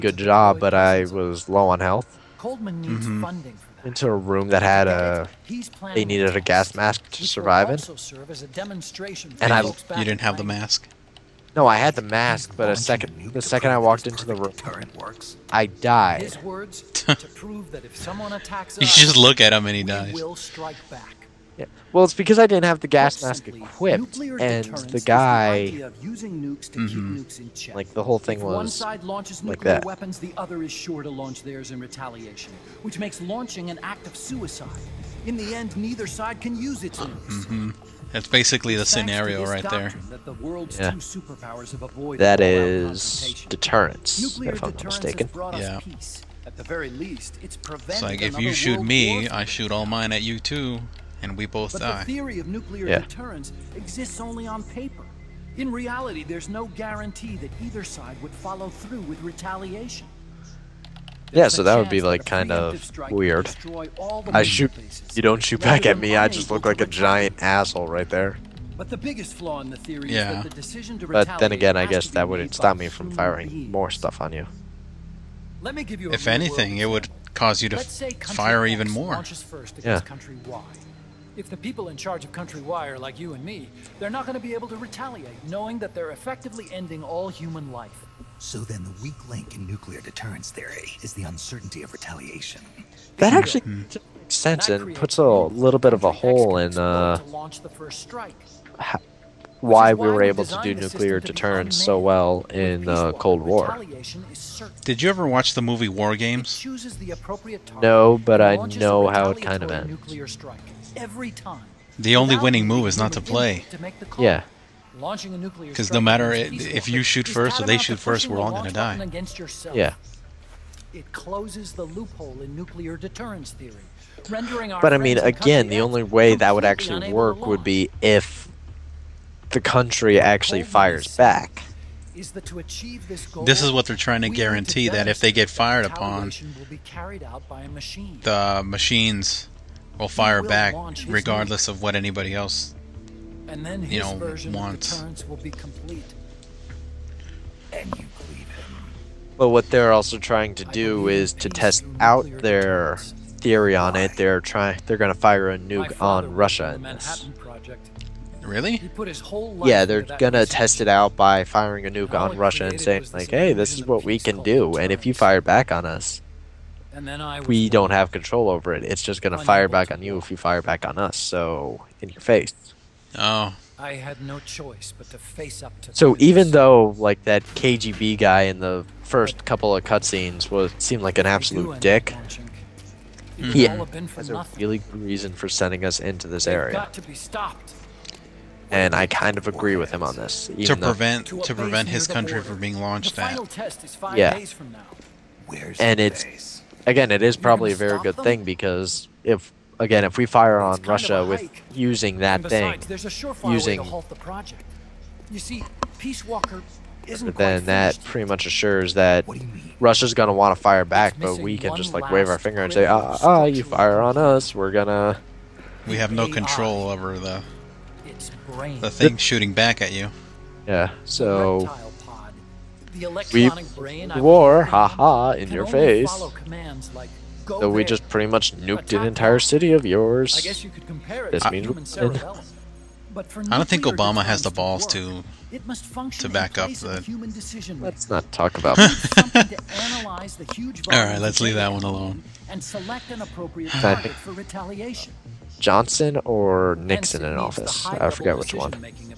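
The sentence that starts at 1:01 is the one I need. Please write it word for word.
Yeah, so that would be like kind of weird.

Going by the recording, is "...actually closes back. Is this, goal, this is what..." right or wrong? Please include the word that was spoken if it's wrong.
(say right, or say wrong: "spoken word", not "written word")
wrong: "fires", not "closes".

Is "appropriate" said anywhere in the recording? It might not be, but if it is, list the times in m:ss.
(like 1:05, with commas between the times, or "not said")
4:03.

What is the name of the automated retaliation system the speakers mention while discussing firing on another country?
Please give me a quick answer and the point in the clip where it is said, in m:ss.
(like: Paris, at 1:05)
Peace Walker, at 3:25.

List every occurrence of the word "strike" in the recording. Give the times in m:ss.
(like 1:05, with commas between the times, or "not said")
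0:20.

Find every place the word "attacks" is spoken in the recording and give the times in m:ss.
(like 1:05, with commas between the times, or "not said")
0:18, 3:48.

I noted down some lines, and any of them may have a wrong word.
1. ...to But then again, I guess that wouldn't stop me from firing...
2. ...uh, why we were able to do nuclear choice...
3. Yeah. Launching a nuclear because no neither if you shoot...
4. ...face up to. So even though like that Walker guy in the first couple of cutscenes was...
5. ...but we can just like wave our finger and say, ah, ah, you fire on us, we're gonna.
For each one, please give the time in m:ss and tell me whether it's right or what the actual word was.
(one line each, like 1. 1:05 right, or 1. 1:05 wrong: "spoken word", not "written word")
1. 1:10 right
2. 1:36 wrong: "deterrence", not "choice"
3. 1:54 wrong: "matter", not "neither"
4. 2:55 wrong: "KGB", not "Walker"
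5. 3:31 right.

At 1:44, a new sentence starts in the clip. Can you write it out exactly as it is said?
Did you ever watch the movie War Games?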